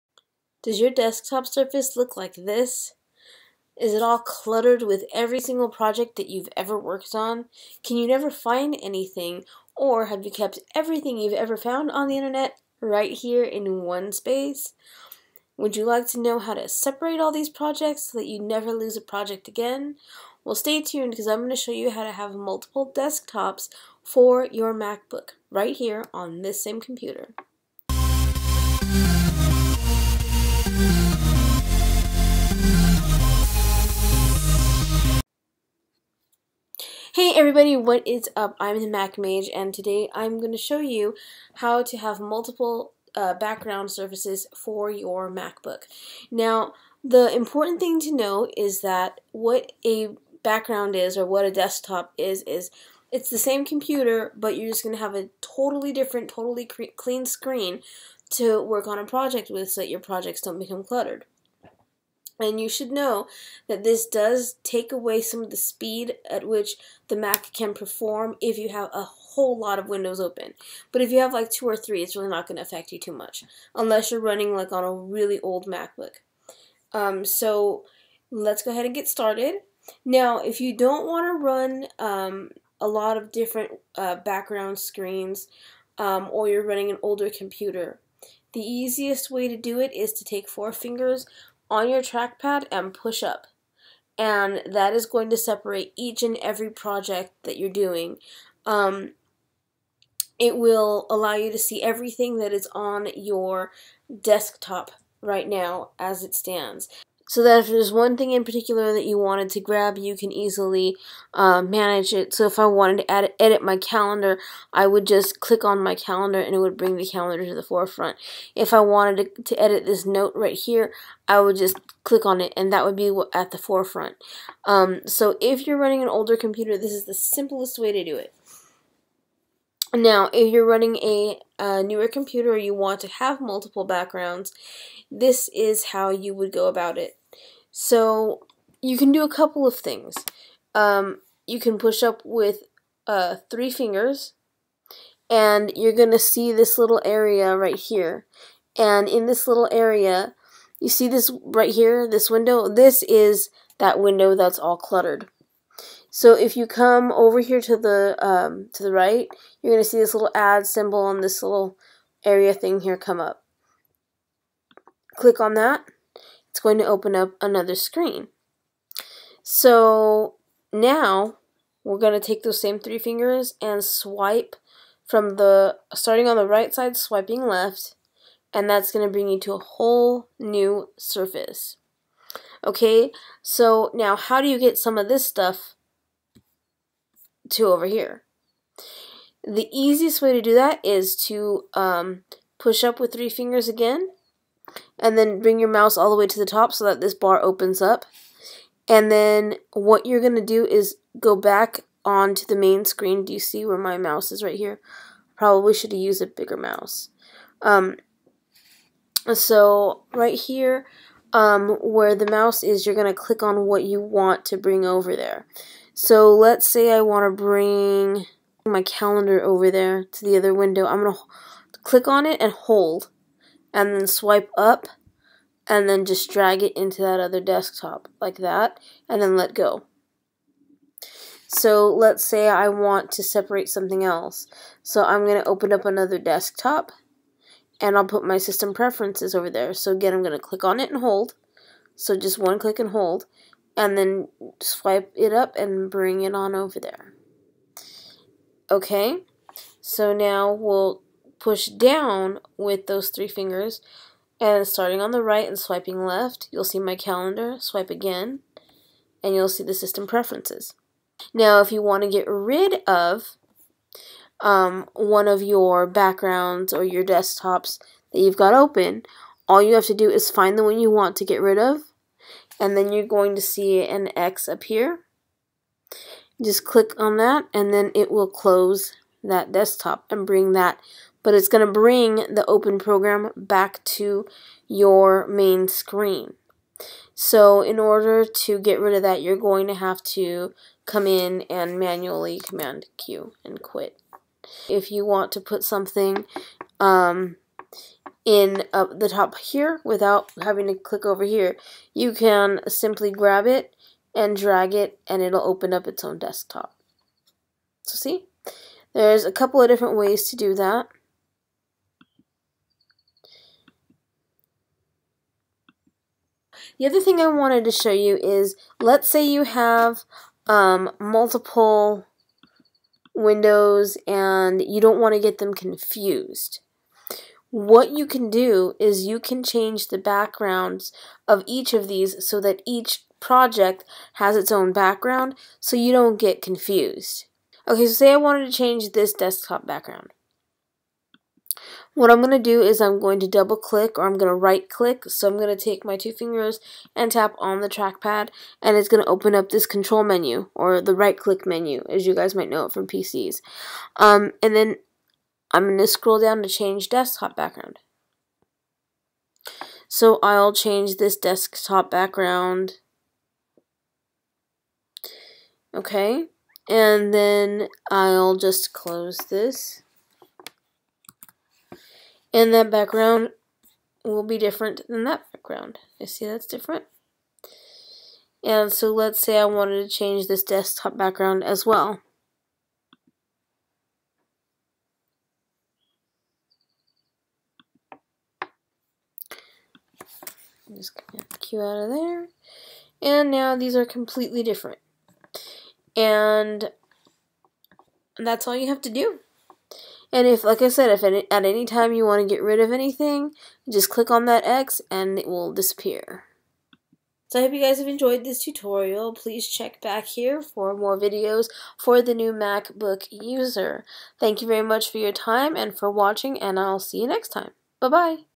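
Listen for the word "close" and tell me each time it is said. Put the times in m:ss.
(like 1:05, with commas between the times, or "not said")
4:38, 6:08.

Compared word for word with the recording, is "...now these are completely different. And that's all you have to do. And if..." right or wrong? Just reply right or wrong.
right.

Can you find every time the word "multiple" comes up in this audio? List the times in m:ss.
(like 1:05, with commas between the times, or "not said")
0:22, 0:42, 2:13, 5:20.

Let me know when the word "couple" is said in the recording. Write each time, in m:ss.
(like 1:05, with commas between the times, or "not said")
2:19, 5:09.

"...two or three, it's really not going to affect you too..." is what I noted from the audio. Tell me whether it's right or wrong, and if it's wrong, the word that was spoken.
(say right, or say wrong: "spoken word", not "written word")
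right.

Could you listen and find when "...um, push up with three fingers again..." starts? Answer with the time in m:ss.
3:11.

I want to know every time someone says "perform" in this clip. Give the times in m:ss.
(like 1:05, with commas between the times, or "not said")
1:07.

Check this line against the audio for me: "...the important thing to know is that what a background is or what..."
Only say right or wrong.
right.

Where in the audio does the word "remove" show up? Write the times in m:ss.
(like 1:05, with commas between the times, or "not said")
not said.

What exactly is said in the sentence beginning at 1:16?
Um, so let's go ahead and get started.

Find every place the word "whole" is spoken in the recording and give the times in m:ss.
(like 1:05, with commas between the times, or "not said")
1:09, 2:59.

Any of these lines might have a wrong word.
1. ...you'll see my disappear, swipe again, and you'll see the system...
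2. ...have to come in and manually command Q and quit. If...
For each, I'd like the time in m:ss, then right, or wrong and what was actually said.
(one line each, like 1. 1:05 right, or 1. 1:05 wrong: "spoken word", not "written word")
1. 4:16 wrong: "calendar", not "disappear"
2. 4:49 right.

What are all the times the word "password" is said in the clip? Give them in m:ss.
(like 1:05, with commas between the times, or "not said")
not said.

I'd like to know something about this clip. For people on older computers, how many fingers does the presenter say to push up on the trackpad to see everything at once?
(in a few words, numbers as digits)
4.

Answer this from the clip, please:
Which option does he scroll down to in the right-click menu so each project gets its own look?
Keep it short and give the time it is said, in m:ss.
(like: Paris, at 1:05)
Change desktop background, at 5:56.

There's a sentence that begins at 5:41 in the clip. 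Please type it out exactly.
What I'm going to do is I'm going to double click or I'm going to right click.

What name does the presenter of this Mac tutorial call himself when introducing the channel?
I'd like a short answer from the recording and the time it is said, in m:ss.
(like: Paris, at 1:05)
The Mac Mage, at 0:38.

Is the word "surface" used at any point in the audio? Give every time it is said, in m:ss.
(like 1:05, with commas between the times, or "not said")
0:01, 0:43, 3:00.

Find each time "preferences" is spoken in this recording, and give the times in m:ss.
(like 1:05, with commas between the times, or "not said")
3:58, 4:20.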